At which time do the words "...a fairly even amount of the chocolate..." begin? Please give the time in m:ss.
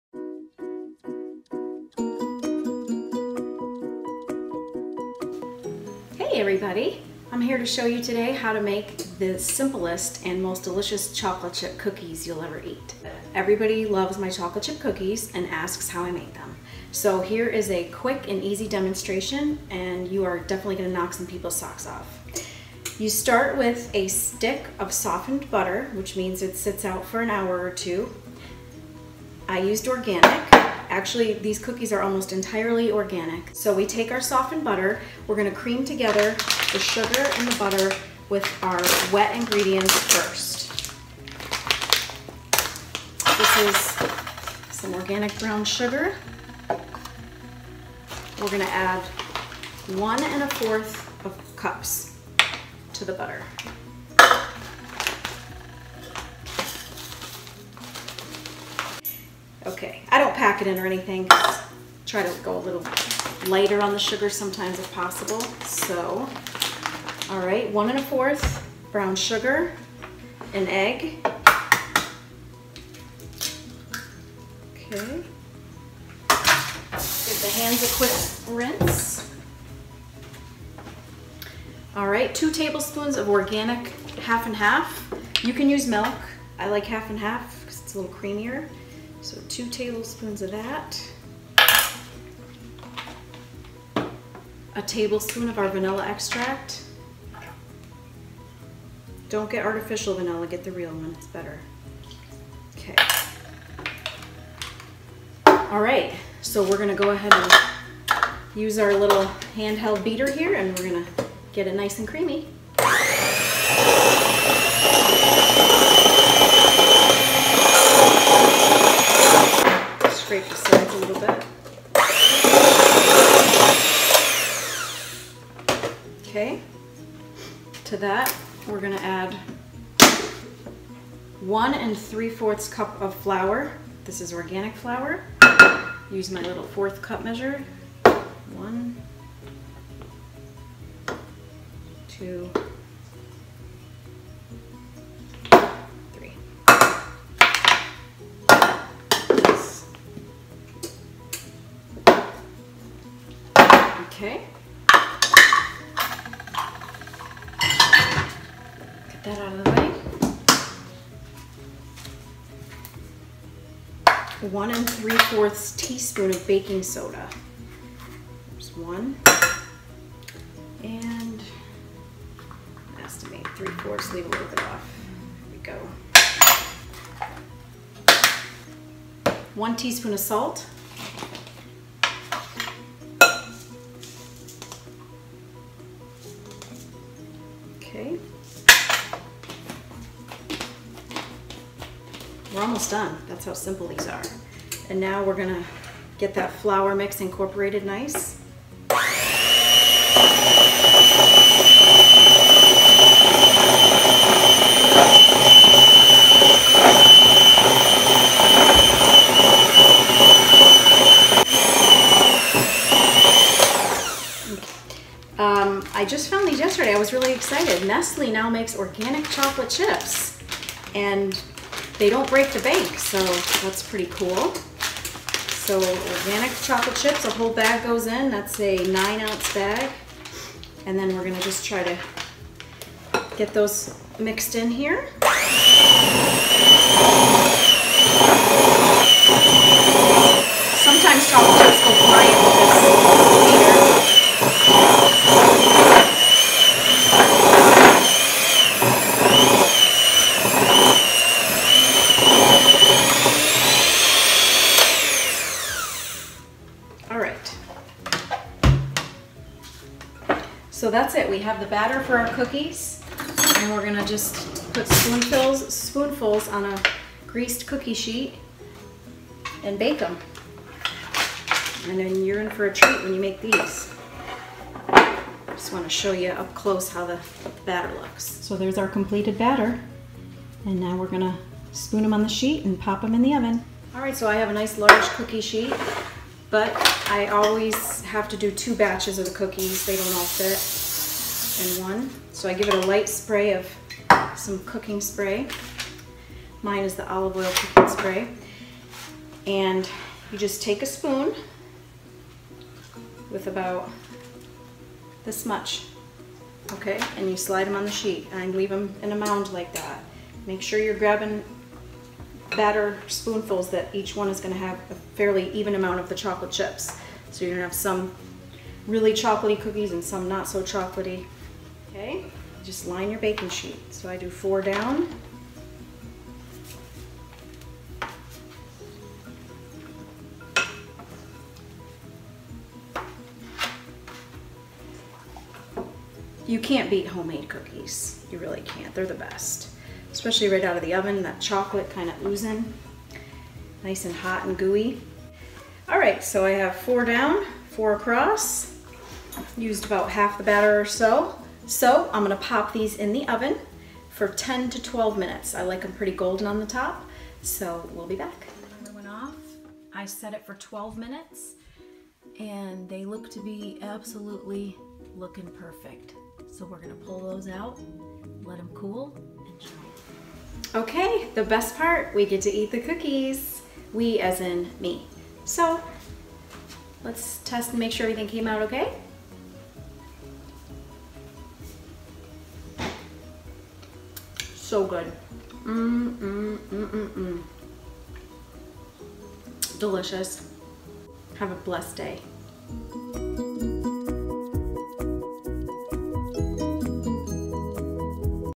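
5:14.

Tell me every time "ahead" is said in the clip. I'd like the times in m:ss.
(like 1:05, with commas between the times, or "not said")
1:47.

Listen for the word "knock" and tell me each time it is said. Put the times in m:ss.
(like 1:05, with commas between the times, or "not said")
0:20.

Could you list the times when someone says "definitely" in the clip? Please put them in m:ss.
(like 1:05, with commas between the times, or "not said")
0:20.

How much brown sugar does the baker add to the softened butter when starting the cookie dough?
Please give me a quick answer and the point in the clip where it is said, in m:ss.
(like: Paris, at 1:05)
1 1/4 cups, at 0:49.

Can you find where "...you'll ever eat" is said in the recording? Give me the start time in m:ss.
0:12.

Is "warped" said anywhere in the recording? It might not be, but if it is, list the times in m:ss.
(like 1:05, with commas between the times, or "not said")
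not said.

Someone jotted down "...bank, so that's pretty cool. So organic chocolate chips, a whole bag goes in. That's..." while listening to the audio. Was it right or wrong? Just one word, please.
right.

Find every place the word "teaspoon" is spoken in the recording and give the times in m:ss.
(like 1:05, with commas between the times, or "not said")
2:45, 2:59.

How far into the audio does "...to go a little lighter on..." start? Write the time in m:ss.
1:02.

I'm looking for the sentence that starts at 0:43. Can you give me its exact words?
This is some organic brown sugar.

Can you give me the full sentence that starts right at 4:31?
And then you're in for a treat when you make these.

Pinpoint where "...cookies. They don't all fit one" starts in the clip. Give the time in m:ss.
4:49.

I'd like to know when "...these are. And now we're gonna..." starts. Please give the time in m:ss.
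3:13.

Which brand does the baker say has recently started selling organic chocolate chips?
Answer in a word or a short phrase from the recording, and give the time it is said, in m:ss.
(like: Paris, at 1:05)
Nestle, at 3:37.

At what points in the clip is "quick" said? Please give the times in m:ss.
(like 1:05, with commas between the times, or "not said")
0:17, 1:17.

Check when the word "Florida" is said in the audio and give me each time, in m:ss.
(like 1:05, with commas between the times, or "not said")
not said.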